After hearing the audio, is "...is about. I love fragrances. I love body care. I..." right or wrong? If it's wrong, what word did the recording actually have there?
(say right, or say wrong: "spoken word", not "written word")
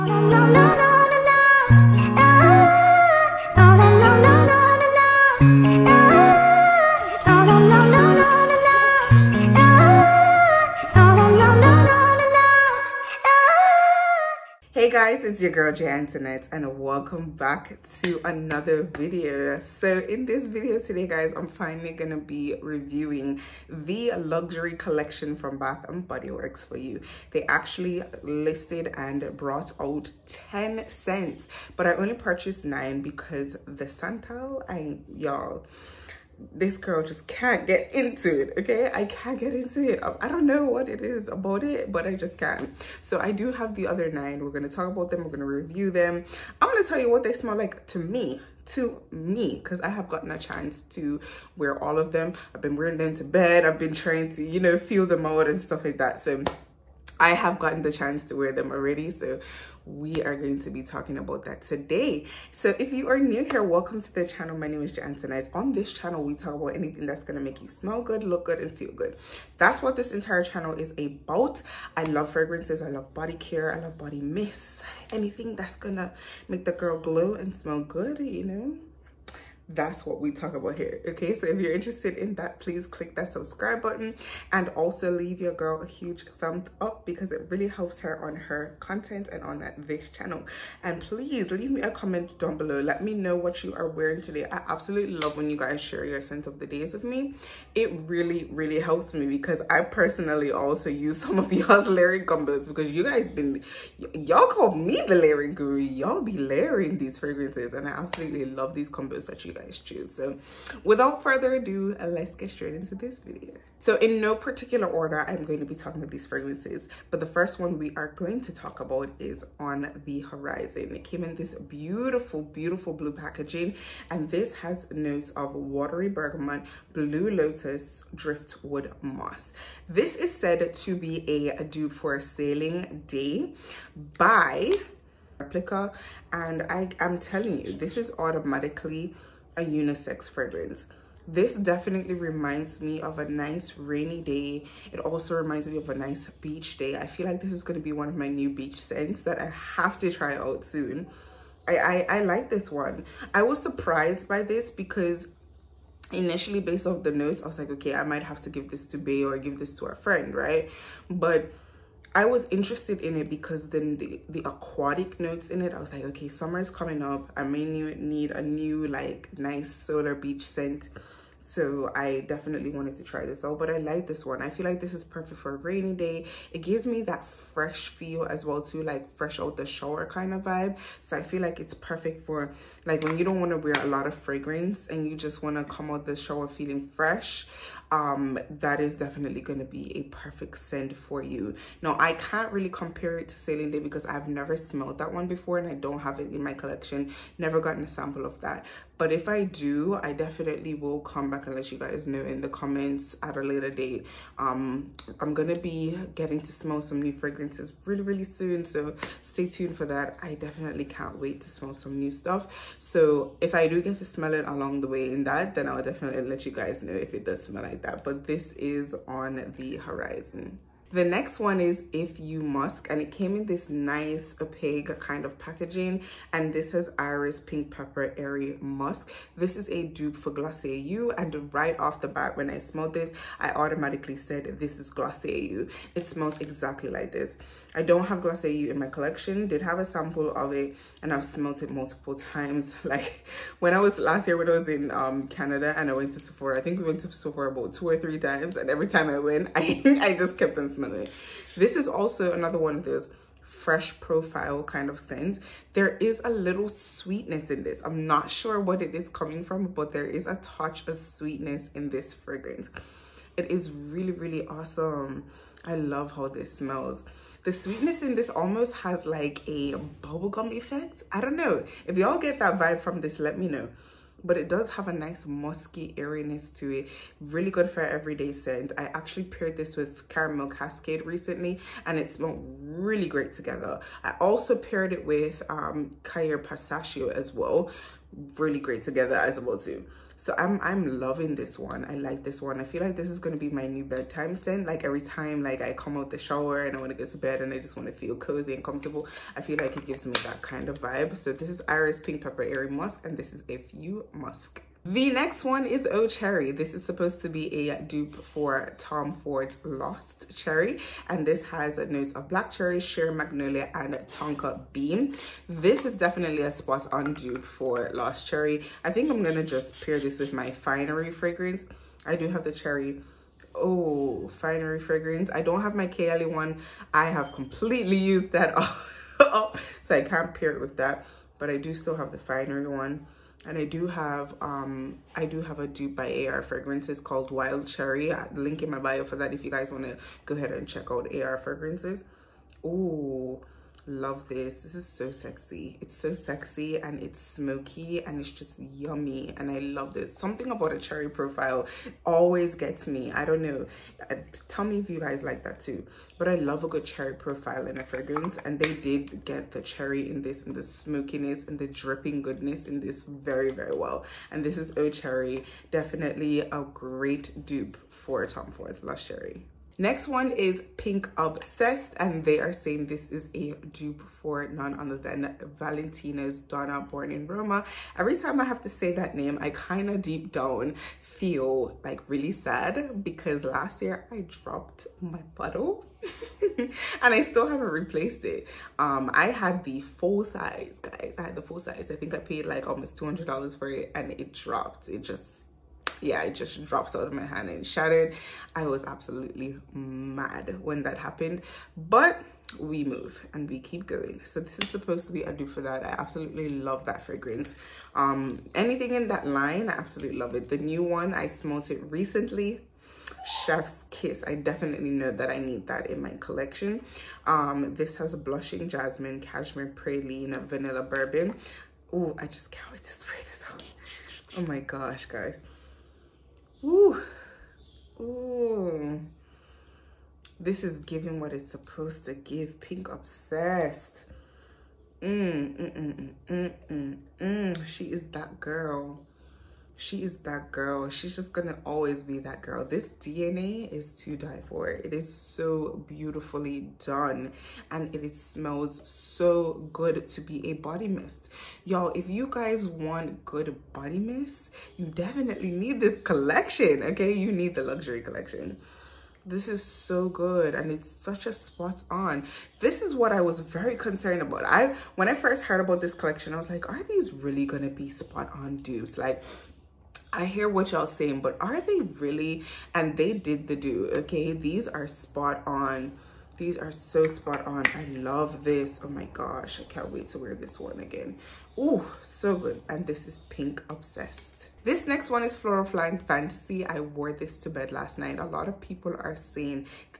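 right.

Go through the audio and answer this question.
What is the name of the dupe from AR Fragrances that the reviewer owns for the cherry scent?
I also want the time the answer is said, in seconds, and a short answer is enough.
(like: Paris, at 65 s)
Wild Cherry, at 337 s.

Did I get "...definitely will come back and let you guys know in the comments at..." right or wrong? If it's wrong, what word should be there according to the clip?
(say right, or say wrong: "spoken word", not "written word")
right.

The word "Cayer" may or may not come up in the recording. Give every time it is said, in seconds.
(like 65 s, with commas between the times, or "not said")
286 s.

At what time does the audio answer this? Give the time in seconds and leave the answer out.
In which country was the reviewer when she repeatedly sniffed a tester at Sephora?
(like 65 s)
245 s.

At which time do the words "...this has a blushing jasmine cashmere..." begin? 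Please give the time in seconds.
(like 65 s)
417 s.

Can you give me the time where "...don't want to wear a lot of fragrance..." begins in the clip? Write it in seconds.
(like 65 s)
183 s.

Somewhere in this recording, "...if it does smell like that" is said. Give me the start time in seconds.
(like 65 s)
216 s.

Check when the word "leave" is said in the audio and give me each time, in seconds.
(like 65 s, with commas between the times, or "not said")
85 s, 91 s.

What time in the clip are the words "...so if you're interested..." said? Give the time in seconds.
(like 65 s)
81 s.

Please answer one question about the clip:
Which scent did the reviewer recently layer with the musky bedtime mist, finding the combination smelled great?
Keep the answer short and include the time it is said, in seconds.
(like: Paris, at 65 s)
Caramel Cascade, at 280 s.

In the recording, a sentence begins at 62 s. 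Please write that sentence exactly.
So if you are new here, welcome to the channel.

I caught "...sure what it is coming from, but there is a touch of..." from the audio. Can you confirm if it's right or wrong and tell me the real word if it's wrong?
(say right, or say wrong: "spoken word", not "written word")
right.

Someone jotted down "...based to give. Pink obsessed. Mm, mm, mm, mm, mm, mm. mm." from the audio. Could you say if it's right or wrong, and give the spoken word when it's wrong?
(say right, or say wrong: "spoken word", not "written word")
wrong: "supposed", not "based".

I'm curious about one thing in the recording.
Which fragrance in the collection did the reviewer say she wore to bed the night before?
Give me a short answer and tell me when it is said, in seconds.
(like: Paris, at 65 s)
Floral Flying Fantasy, at 485 s.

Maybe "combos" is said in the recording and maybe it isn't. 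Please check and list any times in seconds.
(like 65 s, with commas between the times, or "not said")
102 s, 108 s.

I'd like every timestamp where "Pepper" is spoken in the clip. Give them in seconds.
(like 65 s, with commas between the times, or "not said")
227 s, 302 s.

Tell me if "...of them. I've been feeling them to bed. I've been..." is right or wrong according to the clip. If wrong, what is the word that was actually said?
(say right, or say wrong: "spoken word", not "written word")
wrong: "wearing", not "feeling".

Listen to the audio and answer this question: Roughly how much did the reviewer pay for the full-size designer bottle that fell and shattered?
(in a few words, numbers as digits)
$200.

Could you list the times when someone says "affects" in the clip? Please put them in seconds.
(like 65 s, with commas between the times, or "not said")
not said.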